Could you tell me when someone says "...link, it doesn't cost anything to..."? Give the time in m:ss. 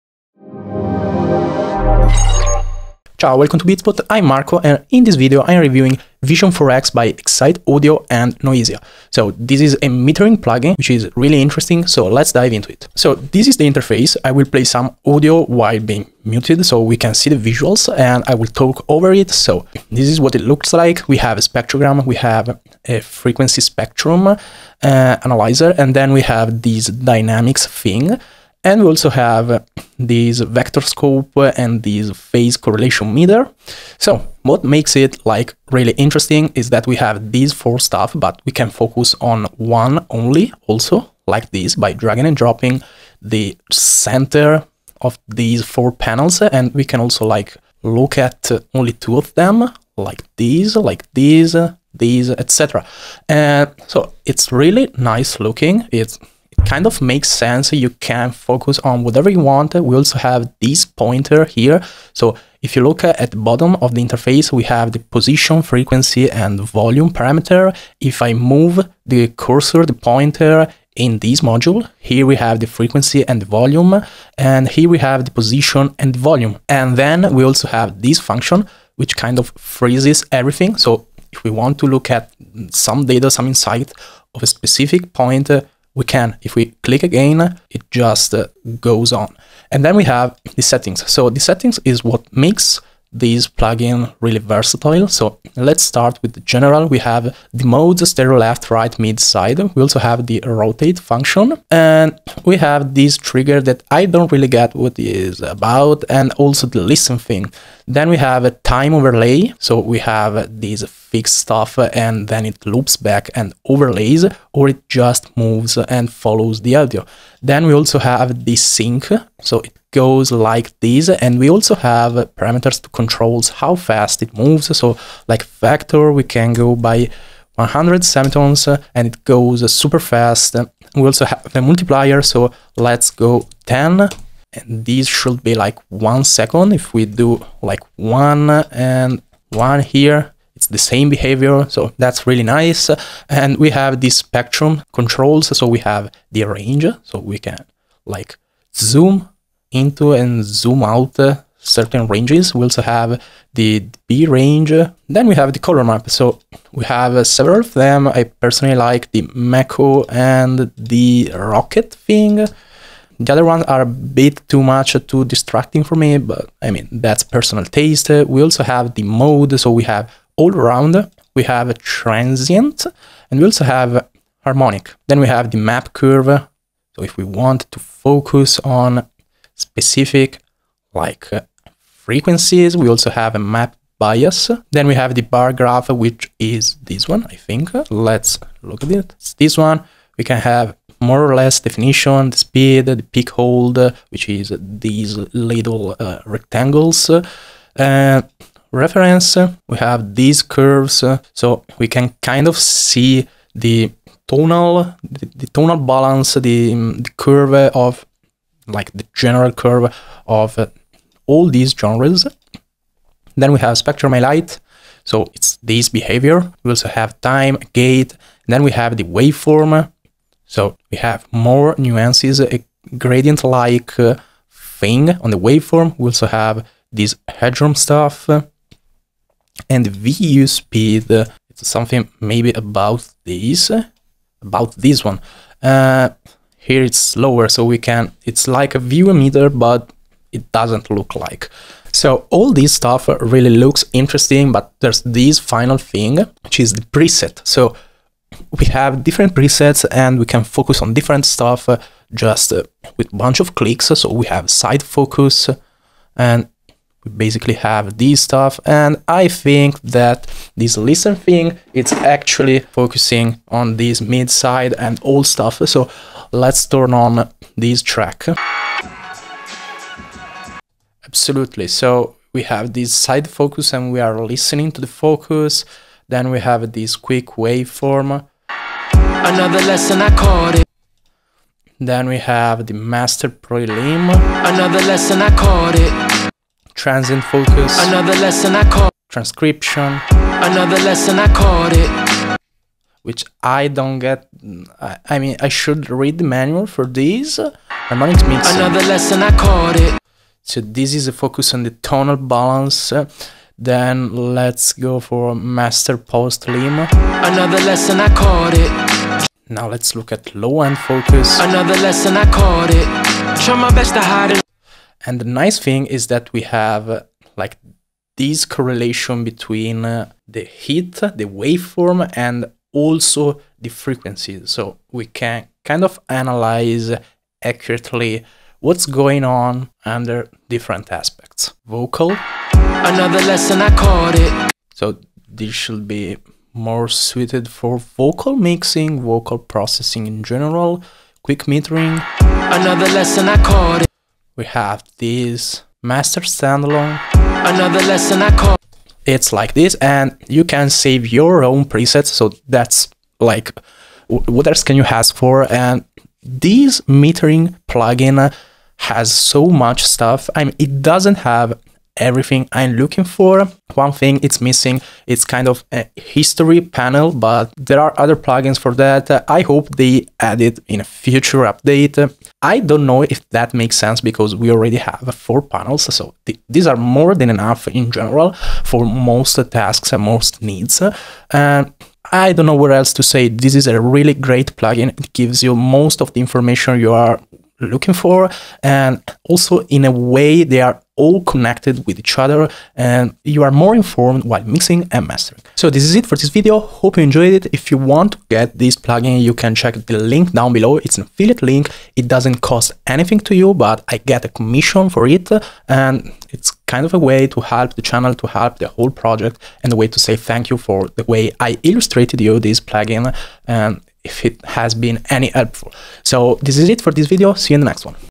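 6:41.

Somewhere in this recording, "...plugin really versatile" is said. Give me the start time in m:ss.
1:33.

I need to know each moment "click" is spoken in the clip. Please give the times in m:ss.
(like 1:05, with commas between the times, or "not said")
1:26, 4:13.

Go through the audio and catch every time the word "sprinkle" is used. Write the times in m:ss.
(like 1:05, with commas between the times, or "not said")
not said.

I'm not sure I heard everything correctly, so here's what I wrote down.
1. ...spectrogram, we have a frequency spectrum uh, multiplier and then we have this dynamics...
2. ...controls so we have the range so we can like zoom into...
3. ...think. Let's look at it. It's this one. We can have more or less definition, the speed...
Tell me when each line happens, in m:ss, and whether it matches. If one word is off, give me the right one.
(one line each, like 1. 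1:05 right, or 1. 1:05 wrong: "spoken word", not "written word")
1. 0:21 wrong: "analyzer", not "multiplier"
2. 2:24 right
3. 3:07 right.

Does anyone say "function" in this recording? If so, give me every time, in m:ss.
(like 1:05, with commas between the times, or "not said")
1:18, 1:40.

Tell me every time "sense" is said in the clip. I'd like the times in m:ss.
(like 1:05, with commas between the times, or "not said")
0:57, 6:13.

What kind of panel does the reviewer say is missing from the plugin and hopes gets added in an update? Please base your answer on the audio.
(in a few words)
A history panel.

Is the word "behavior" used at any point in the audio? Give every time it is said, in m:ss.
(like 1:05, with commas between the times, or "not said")
2:21, 3:35.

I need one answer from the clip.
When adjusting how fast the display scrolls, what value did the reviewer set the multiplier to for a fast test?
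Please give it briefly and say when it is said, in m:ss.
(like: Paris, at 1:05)
10, at 2:13.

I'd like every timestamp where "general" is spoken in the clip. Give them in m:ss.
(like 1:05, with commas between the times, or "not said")
1:36, 3:29, 5:40, 6:17.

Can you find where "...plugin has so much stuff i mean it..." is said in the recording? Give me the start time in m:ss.
5:57.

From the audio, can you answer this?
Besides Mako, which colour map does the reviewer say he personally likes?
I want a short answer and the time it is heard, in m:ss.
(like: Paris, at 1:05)
Rocket, at 2:41.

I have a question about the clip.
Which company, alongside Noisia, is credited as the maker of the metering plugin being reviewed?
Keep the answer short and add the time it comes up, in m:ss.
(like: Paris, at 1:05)
Excite Audio, at 0:07.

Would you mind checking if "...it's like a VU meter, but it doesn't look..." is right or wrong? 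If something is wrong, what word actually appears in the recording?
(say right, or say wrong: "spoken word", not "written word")
right.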